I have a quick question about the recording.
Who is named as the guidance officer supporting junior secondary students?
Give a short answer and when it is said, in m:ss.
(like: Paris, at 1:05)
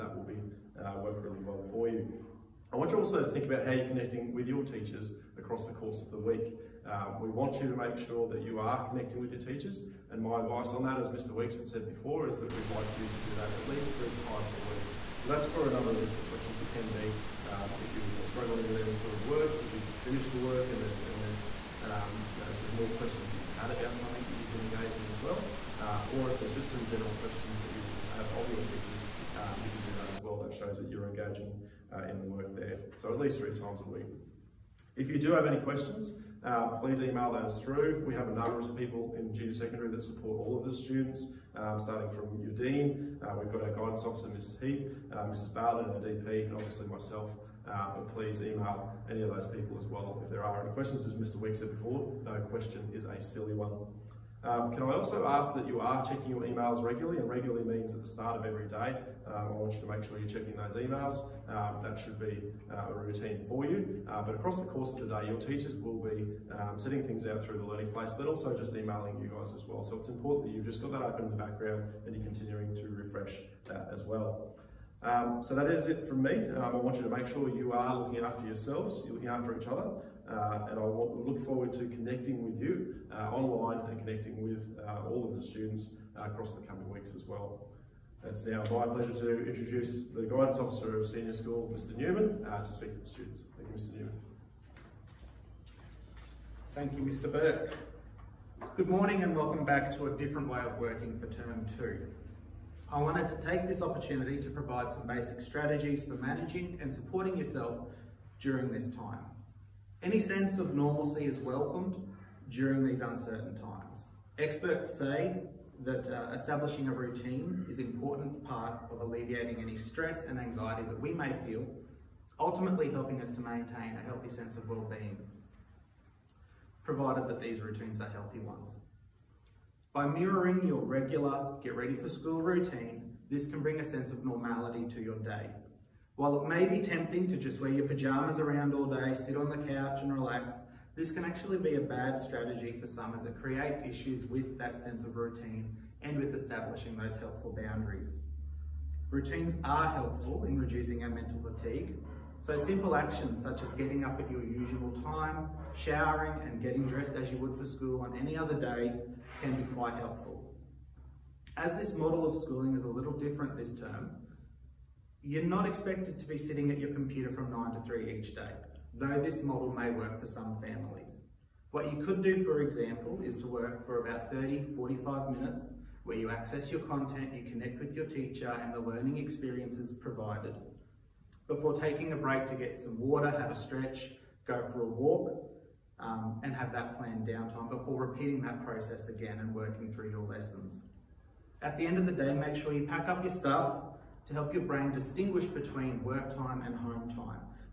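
Mrs. Heap, at 0:44.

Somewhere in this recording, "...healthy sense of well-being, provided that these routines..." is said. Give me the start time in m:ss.
2:04.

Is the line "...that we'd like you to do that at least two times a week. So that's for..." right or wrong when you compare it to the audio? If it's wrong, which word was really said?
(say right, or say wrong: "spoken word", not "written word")
wrong: "three", not "two".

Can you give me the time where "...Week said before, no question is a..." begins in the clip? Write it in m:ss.
0:51.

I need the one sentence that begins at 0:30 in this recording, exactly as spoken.
That shows that you're engaging uh, in the work there.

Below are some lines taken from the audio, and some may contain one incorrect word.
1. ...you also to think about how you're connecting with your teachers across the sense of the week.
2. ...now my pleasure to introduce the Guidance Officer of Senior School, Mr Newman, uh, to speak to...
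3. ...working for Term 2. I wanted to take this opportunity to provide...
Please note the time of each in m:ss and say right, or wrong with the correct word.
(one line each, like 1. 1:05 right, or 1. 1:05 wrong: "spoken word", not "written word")
1. 0:02 wrong: "course", not "sense"
2. 1:28 right
3. 1:40 right.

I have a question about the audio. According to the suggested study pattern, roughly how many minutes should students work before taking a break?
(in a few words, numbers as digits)
30-45 minutes.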